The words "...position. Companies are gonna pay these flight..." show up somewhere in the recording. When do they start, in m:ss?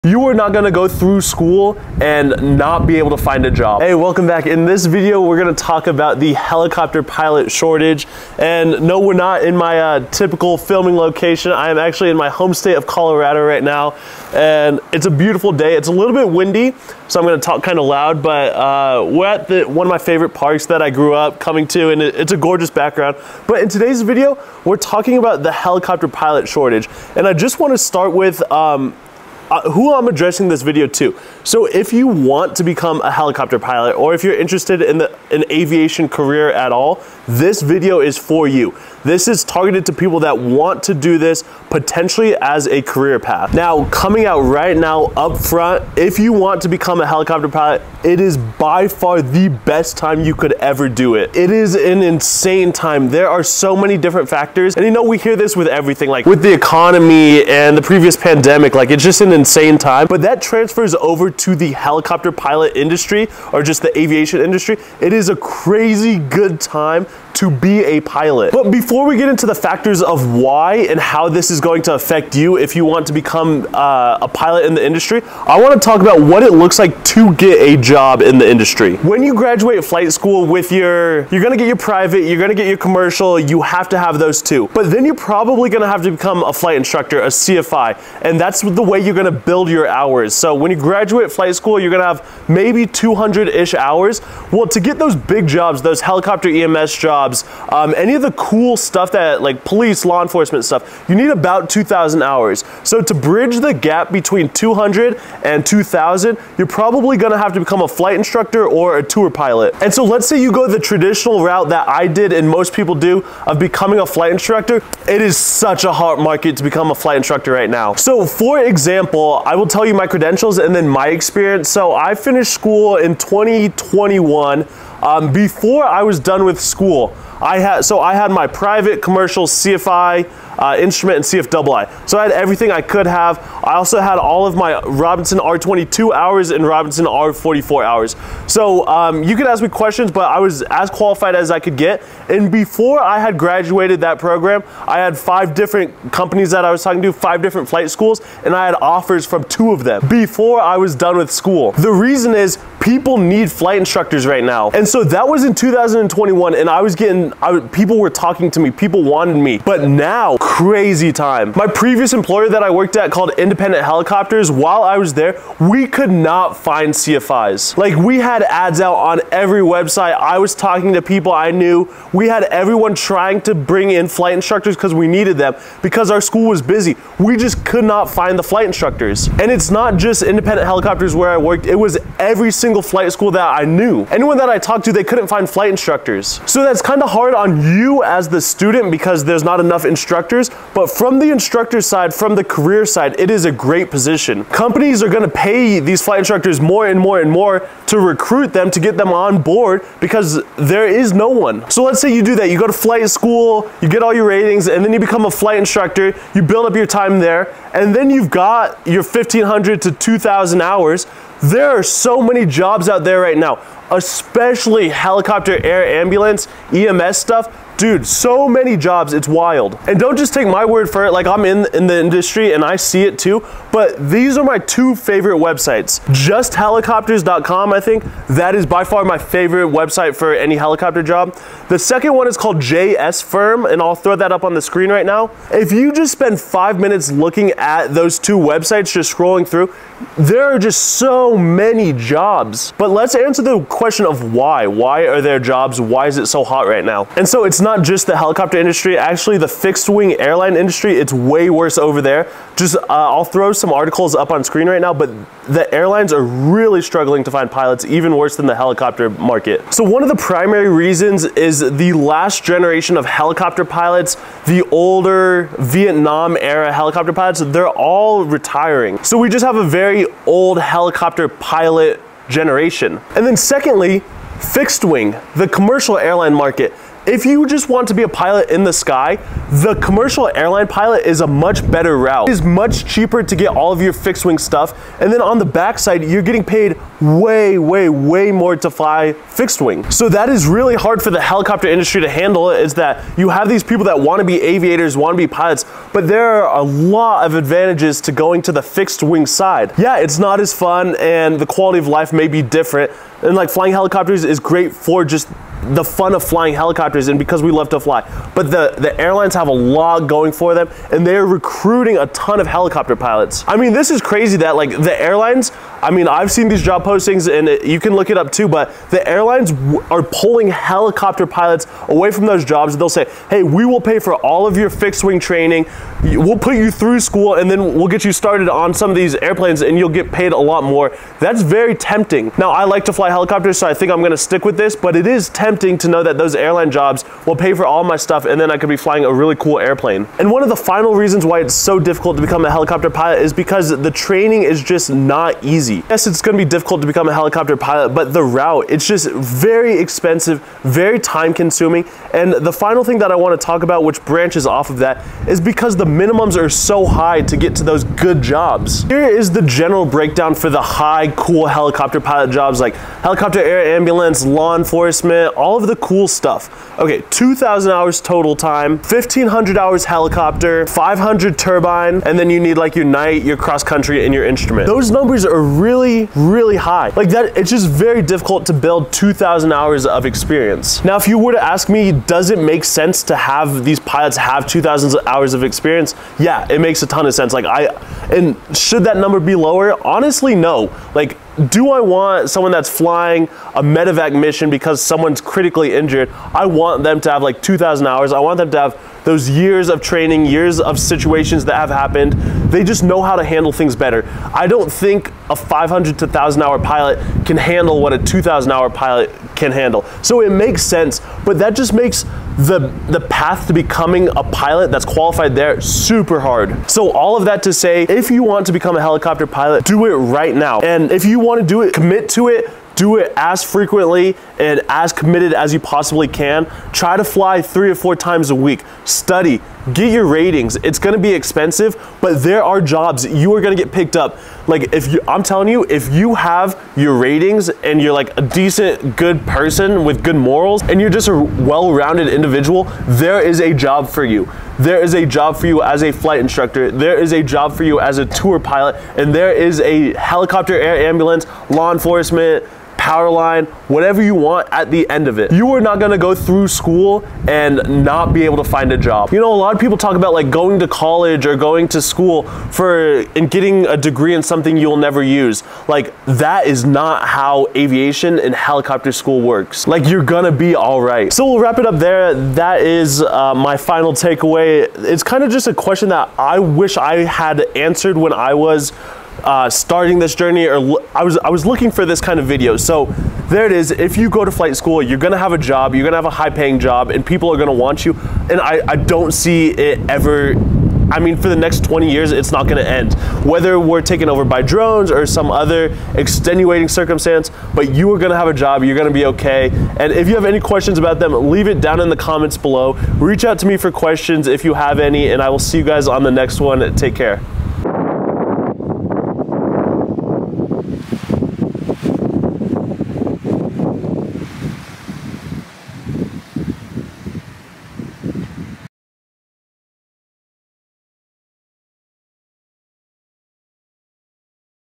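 3:13.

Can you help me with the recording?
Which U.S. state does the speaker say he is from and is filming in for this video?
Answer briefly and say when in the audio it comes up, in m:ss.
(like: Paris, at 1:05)
Colorado, at 0:12.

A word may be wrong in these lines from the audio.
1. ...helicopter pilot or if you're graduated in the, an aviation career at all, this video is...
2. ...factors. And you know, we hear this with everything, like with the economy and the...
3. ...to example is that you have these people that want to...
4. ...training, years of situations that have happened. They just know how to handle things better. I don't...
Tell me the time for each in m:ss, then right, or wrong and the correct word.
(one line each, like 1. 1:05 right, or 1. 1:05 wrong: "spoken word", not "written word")
1. 0:33 wrong: "interested", not "graduated"
2. 0:54 right
3. 4:52 wrong: "handle", not "example"
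4. 6:39 right.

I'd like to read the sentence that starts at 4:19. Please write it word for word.
So one of the primary reasons is the last generation of helicopter pilots, the older Vietnam era helicopter pilots, they're all retiring.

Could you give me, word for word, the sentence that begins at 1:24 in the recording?
But then you're probably gonna have to become a flight instructor, a CFI, and that's the way you're gonna build your hours.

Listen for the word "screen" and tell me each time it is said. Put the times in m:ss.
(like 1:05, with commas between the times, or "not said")
3:54, 4:14.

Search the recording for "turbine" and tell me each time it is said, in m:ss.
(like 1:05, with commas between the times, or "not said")
6:11.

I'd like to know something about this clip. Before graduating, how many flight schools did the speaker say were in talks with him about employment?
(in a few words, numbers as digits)
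5.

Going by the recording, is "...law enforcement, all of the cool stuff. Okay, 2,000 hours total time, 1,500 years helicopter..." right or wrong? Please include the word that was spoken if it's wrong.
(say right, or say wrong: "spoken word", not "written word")
wrong: "hours", not "years".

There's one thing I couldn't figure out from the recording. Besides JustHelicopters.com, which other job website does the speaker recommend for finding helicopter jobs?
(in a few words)
JS Firm.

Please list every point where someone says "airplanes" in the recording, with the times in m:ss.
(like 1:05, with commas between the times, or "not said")
5:29, 5:39.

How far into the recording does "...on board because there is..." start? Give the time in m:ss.
3:19.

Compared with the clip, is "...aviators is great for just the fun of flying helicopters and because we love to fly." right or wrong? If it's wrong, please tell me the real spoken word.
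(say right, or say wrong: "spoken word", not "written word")
wrong: "helicopters", not "aviators".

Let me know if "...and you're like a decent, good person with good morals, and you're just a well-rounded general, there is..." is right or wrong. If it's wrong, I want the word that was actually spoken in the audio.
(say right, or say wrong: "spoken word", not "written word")
wrong: "individual", not "general".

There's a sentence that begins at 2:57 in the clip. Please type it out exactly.
We just could not find the flight instructors.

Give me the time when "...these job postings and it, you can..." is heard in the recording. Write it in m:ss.
5:16.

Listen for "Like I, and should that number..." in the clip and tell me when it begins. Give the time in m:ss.
6:27.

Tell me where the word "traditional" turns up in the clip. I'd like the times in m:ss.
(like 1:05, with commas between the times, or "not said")
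1:50.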